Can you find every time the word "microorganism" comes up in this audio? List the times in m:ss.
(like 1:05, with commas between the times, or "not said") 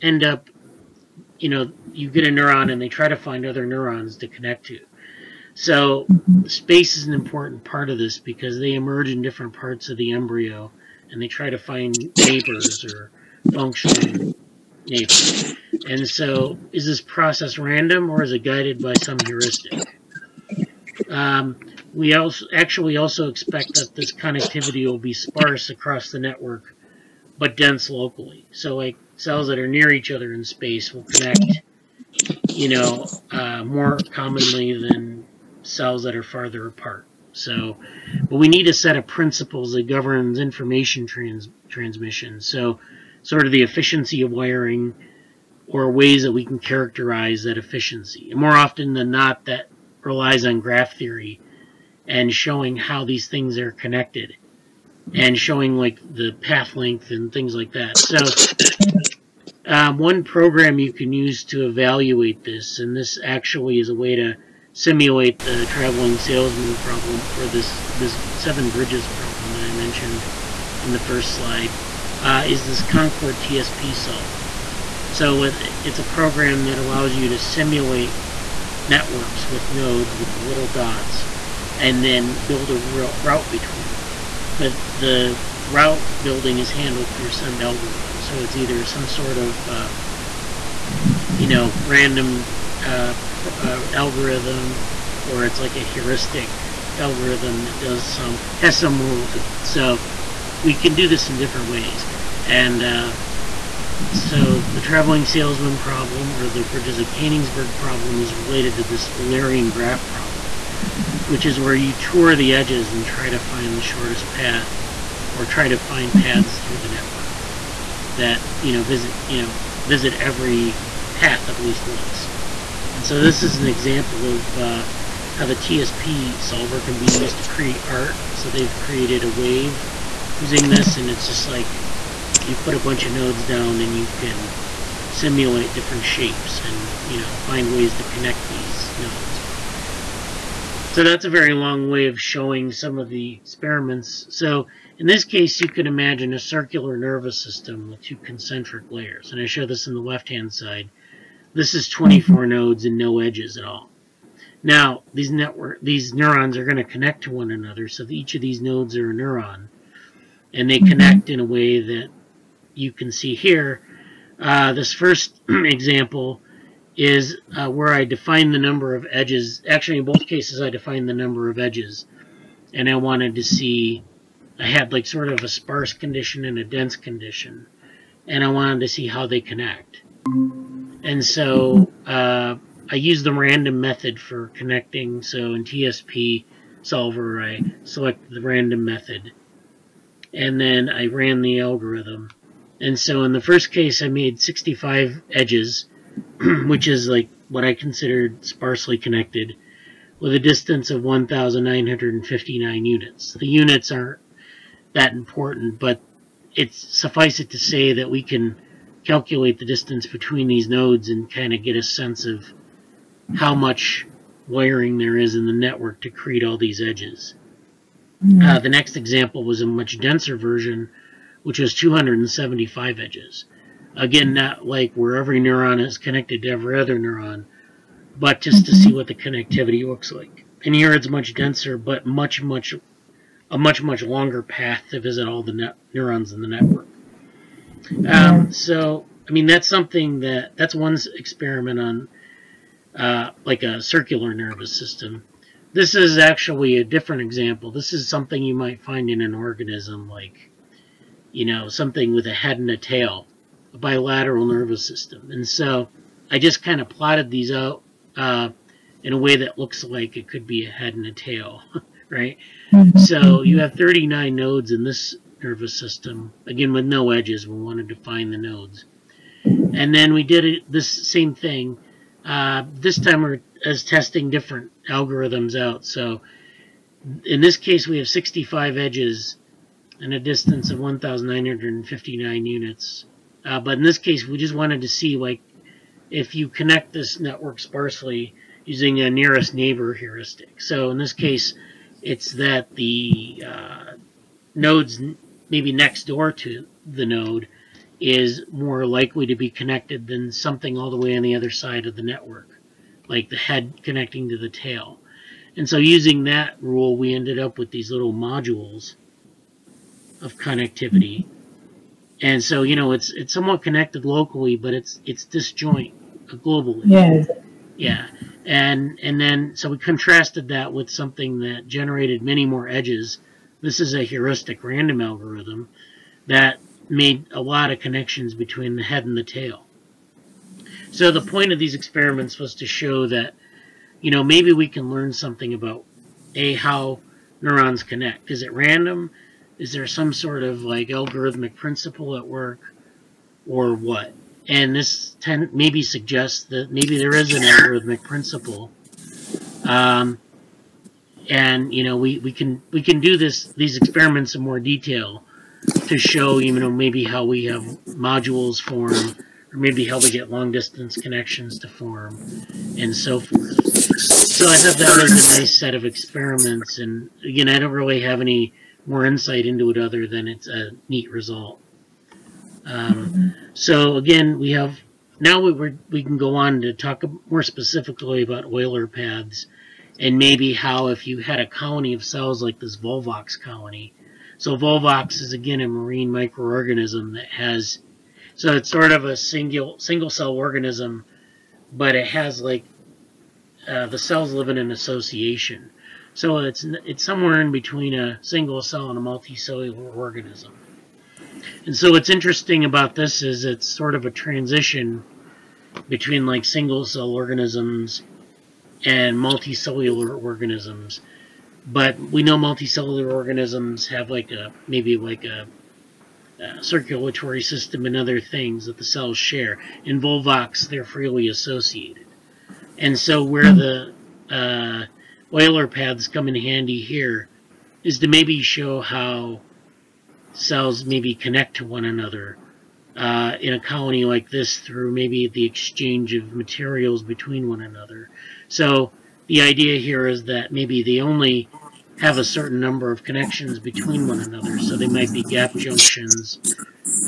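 6:26.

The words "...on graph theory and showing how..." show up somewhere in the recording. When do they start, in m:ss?
0:50.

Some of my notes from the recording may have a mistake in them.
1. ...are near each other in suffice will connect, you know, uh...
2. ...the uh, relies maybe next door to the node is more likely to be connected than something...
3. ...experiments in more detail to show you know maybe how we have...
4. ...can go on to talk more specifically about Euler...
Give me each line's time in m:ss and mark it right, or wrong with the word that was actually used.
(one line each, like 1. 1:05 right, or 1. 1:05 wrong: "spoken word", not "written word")
1. 0:29 wrong: "space", not "suffice"
2. 4:52 wrong: "nodes", not "relies"
3. 5:53 right
4. 6:16 right.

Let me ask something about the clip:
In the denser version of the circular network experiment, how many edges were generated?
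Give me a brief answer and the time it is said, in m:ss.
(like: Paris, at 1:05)
275, at 3:41.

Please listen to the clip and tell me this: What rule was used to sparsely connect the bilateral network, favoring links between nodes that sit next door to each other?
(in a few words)
nearest neighbor heuristic.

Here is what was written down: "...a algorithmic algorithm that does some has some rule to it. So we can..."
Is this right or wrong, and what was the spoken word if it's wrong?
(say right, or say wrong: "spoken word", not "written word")
wrong: "heuristic", not "algorithmic".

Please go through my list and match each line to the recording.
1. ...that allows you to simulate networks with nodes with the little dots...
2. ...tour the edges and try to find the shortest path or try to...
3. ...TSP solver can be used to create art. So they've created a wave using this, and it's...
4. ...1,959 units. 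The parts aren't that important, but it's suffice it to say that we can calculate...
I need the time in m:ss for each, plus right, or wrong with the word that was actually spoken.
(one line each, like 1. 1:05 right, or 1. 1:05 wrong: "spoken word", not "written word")
1. 1:16 right
2. 1:51 right
3. 2:05 right
4. 3:21 wrong: "units", not "parts".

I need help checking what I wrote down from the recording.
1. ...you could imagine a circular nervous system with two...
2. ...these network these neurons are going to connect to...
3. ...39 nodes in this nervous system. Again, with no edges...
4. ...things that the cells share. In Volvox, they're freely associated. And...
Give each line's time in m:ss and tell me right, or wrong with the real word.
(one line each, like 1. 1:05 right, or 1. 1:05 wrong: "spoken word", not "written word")
1. 2:25 right
2. 2:35 right
3. 4:23 right
4. 6:58 right.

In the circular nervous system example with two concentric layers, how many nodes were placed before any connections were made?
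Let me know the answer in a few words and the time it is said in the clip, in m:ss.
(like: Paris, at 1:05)
24, at 2:31.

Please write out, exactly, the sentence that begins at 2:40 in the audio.
connect in a way that you can see here.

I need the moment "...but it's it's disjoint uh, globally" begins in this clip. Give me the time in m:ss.
5:14.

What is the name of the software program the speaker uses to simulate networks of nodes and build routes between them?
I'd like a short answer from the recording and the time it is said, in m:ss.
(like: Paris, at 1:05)
Concorde TSP solver, at 1:12.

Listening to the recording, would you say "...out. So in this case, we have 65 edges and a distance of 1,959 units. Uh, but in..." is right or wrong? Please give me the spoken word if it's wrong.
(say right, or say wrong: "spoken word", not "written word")
right.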